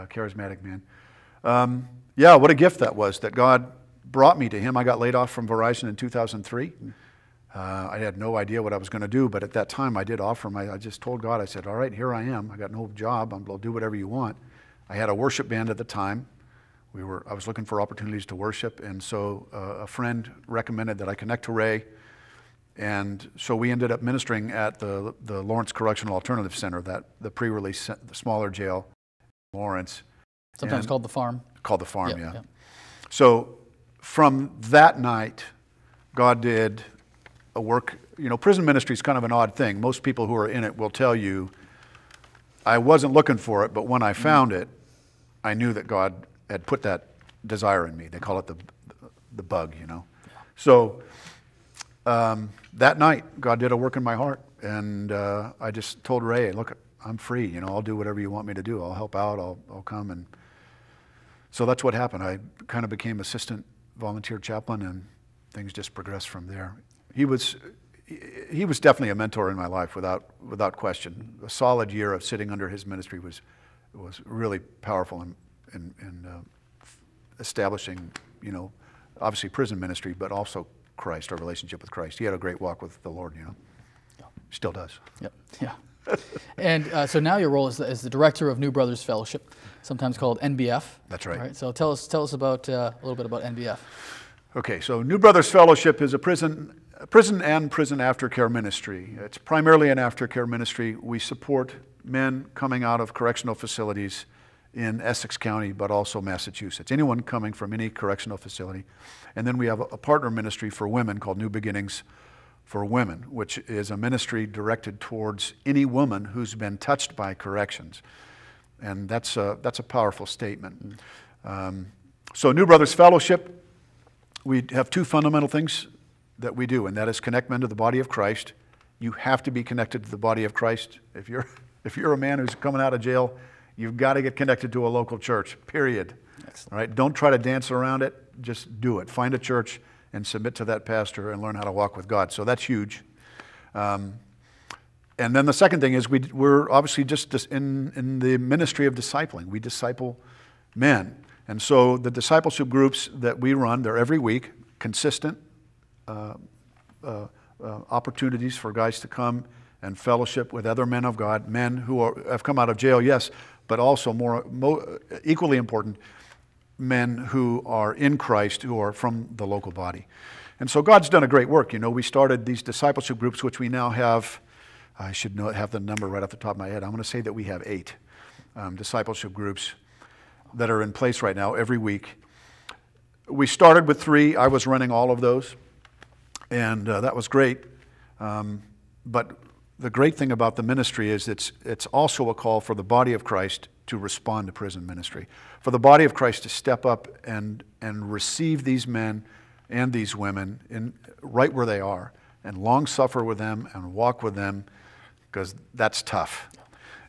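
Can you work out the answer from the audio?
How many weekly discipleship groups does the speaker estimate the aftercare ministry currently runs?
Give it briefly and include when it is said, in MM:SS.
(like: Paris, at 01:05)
8, at 02:57.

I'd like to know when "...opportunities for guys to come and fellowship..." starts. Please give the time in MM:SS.
02:37.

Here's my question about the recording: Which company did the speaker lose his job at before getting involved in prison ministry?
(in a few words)
Verizon.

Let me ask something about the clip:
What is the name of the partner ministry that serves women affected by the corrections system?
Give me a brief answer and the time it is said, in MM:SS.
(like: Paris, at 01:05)
New Beginnings for Women, at 01:51.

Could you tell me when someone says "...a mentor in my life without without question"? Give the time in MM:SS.
01:09.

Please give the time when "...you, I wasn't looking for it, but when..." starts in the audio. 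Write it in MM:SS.
00:41.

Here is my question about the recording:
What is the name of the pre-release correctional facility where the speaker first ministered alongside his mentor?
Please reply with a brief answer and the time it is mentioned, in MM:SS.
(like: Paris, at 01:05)
Lawrence Correctional Alternative Center, at 00:25.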